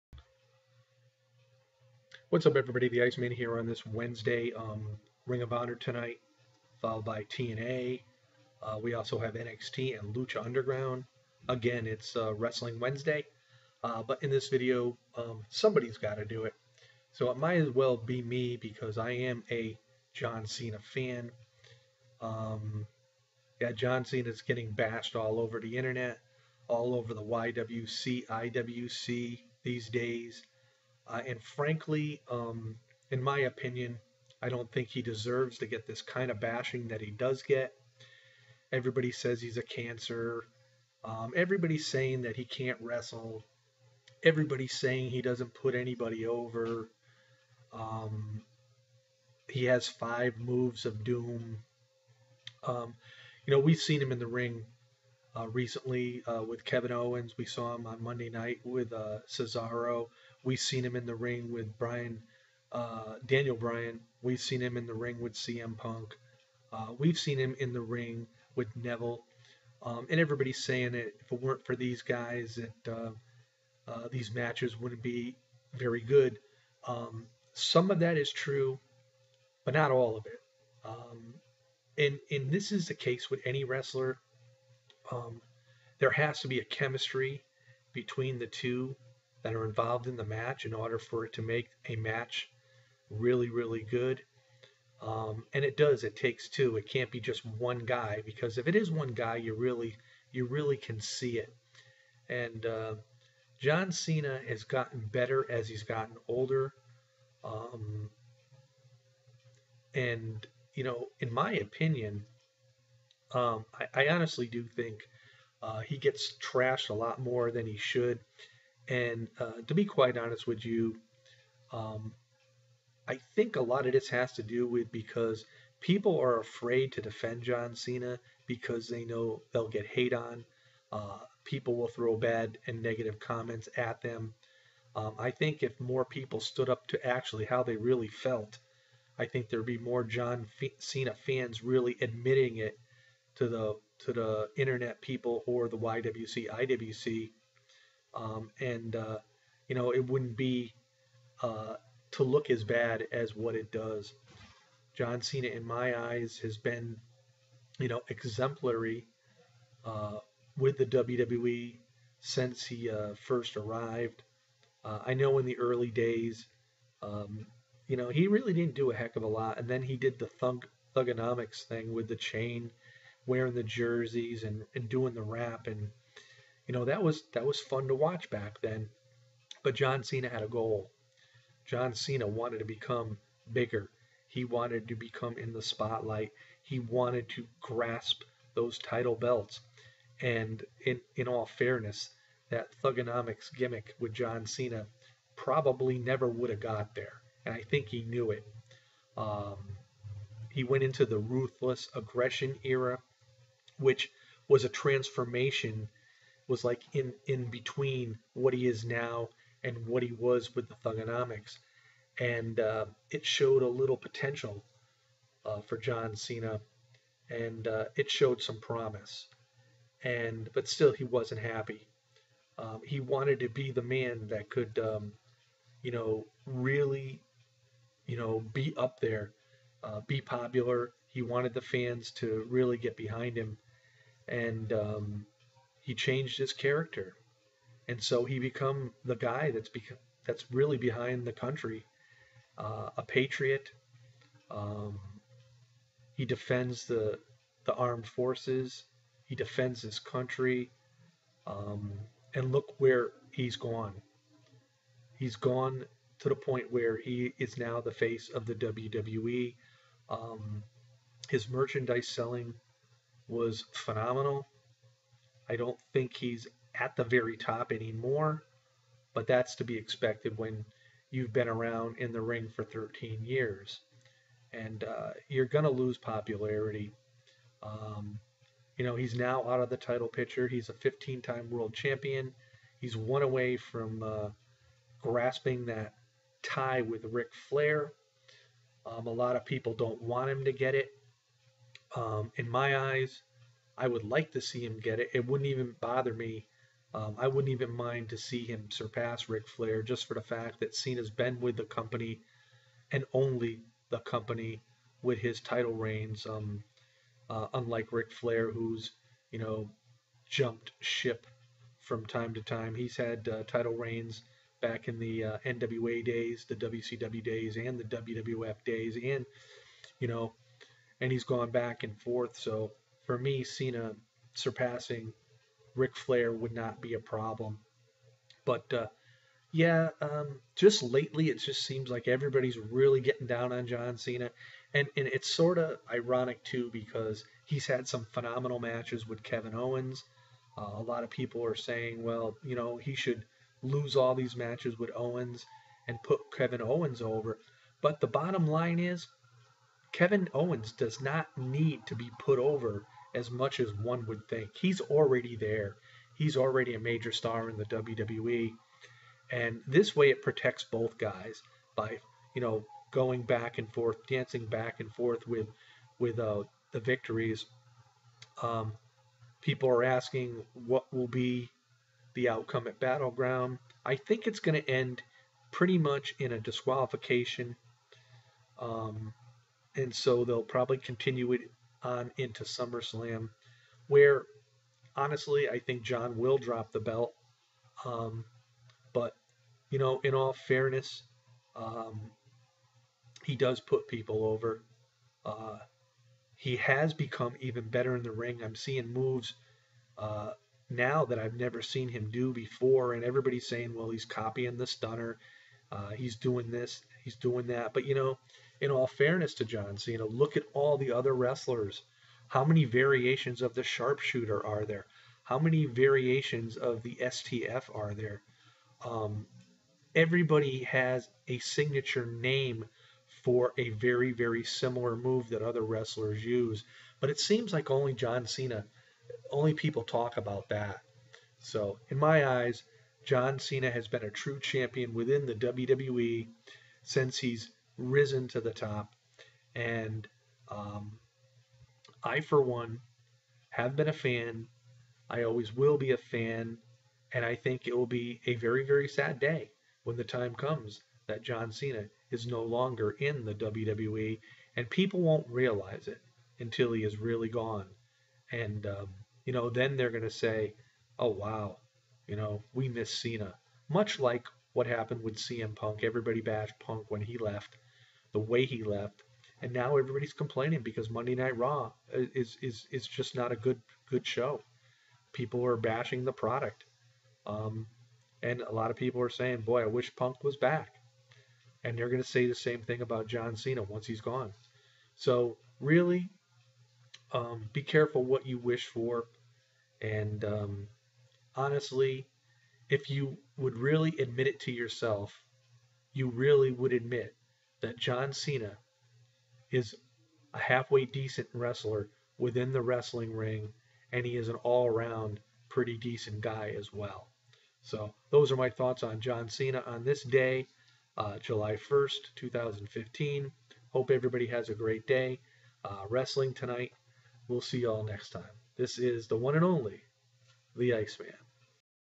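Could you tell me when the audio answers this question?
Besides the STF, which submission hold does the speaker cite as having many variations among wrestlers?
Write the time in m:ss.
6:53.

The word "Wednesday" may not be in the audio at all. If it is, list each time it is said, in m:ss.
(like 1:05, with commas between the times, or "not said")
0:03, 0:12.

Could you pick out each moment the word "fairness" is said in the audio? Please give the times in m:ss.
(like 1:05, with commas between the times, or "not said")
3:11, 6:30, 6:48.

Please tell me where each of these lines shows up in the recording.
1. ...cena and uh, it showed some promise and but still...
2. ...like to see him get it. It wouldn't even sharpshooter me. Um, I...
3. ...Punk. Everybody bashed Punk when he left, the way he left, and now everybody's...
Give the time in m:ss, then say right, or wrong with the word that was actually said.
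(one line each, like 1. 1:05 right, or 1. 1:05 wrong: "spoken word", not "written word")
1. 3:36 right
2. 4:54 wrong: "bother", not "sharpshooter"
3. 7:45 right.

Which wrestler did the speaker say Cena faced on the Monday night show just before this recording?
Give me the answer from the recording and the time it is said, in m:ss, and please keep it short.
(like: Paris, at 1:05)
Cesaro, at 0:59.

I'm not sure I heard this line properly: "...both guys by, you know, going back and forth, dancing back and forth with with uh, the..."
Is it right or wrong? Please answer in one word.
right.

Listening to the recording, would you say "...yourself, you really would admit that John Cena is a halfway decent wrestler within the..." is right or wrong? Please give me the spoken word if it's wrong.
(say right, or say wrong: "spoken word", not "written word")
right.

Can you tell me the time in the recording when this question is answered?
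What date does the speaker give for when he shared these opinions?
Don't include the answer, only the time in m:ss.
8:31.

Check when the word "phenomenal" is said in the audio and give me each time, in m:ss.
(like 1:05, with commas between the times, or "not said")
4:23, 5:38.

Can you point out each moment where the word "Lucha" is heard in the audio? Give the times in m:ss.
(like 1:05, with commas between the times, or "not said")
0:10.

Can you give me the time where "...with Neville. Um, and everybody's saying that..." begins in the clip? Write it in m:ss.
1:08.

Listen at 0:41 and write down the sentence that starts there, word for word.
Um, everybody's saying that he can't wrestle.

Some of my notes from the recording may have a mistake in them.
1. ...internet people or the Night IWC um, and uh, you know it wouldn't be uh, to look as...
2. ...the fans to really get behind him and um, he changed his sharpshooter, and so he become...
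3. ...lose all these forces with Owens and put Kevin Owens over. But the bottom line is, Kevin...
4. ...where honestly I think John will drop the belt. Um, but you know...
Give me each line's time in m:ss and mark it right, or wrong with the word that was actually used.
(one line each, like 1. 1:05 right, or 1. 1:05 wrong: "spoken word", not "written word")
1. 2:24 wrong: "YWC", not "Night"
2. 3:51 wrong: "character", not "sharpshooter"
3. 5:43 wrong: "matches", not "forces"
4. 6:23 right.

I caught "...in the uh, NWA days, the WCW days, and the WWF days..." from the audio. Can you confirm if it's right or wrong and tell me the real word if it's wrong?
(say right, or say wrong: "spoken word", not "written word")
right.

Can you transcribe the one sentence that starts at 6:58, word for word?
Um, everybody has a signature name for a very, very similar move that other wrestlers use.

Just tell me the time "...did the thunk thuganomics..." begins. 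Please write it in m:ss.
2:49.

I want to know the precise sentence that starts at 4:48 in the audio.
Um, a lot of people don't want him to get it.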